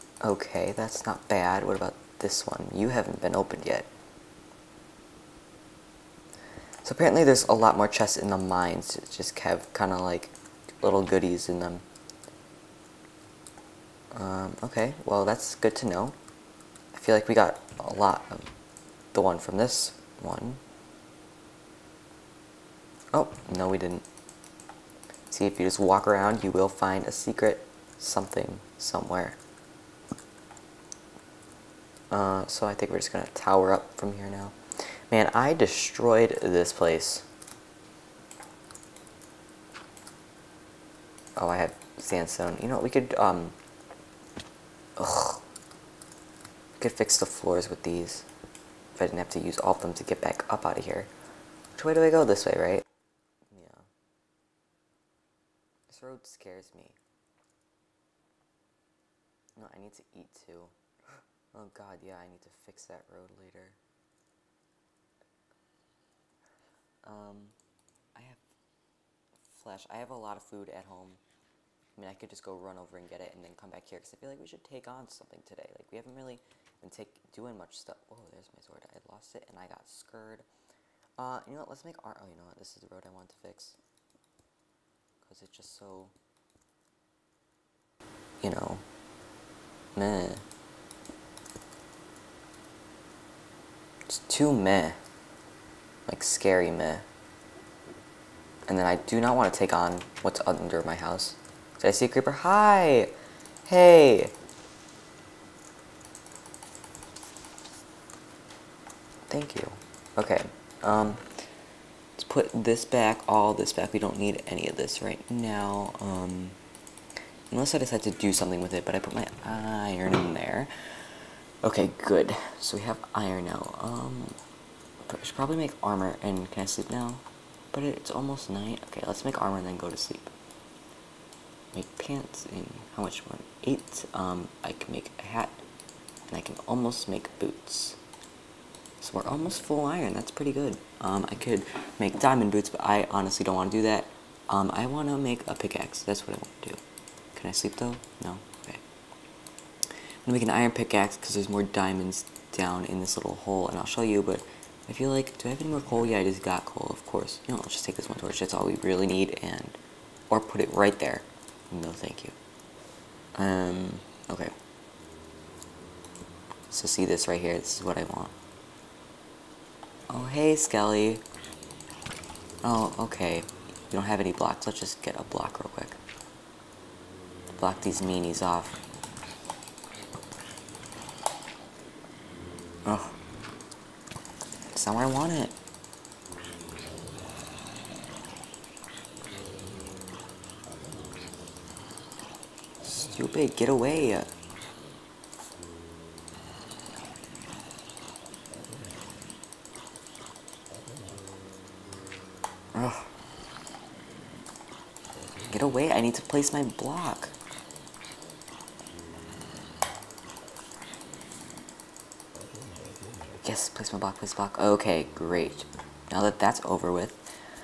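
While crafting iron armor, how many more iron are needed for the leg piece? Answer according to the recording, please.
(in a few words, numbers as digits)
8.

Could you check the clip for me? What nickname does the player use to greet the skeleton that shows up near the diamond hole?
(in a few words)
Skelly.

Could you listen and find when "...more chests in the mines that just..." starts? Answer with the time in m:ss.
0:07.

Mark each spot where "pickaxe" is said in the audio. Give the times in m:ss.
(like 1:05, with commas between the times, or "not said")
2:25, 2:30.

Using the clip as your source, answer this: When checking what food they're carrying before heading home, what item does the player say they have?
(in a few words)
flesh.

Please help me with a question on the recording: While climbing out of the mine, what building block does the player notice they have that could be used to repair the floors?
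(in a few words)
sandstone.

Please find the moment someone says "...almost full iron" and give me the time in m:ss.
2:19.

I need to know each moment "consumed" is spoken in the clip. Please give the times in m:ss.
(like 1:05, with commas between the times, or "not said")
not said.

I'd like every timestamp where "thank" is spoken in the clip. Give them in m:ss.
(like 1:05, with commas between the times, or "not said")
1:49, 2:41.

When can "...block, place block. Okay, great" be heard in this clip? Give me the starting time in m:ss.
3:33.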